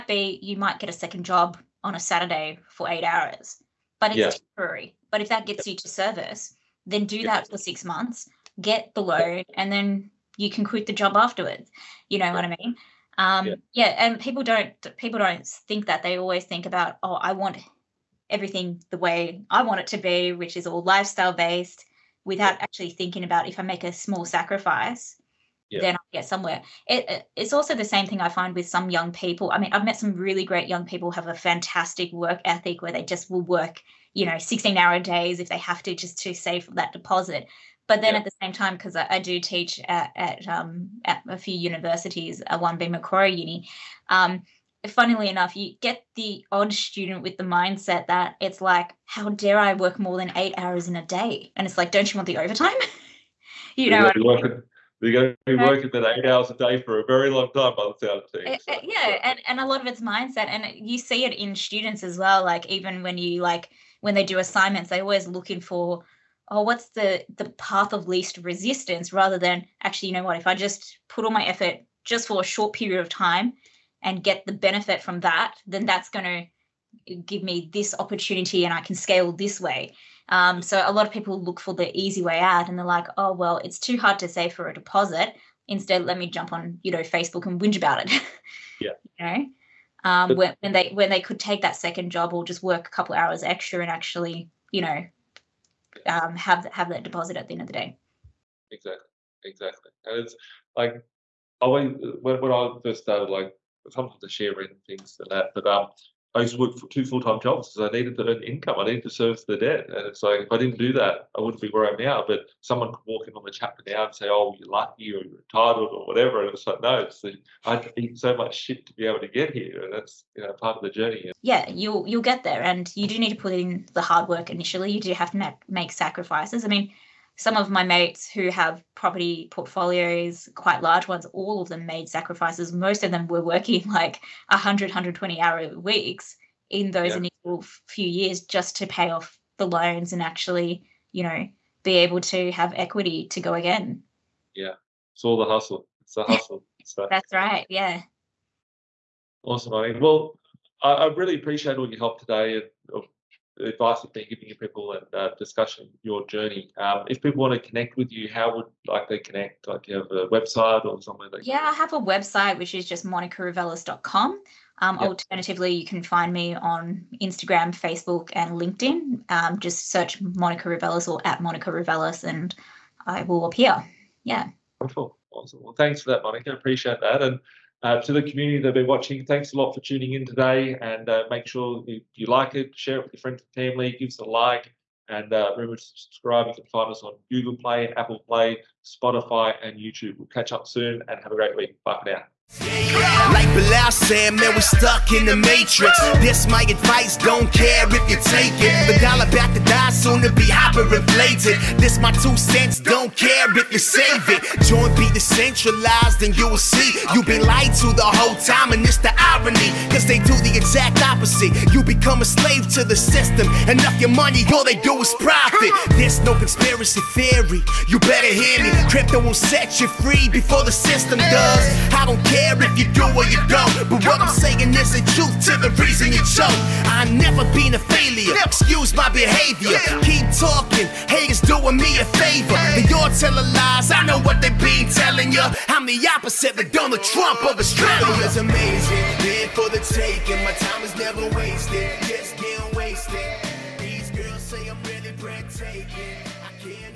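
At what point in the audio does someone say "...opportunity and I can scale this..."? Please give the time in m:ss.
1:17.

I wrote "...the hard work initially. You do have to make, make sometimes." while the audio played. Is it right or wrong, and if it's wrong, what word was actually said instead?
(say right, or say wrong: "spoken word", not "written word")
wrong: "sacrifices", not "sometimes".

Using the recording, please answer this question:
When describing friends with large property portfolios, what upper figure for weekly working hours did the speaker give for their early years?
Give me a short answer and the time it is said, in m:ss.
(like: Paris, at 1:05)
120, at 2:14.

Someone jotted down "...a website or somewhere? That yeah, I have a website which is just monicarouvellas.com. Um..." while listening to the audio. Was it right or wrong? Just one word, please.
right.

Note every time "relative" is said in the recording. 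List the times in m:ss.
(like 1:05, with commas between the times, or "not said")
not said.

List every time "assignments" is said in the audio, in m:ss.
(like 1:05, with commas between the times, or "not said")
1:04.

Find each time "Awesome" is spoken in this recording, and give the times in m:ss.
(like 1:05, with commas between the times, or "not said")
2:29, 2:55.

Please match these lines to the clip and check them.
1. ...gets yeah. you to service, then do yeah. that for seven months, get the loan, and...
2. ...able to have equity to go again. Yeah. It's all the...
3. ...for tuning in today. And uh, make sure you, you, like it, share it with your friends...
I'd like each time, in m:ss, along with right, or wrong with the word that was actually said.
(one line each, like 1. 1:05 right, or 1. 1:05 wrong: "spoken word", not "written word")
1. 0:05 wrong: "six", not "seven"
2. 2:21 right
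3. 2:59 right.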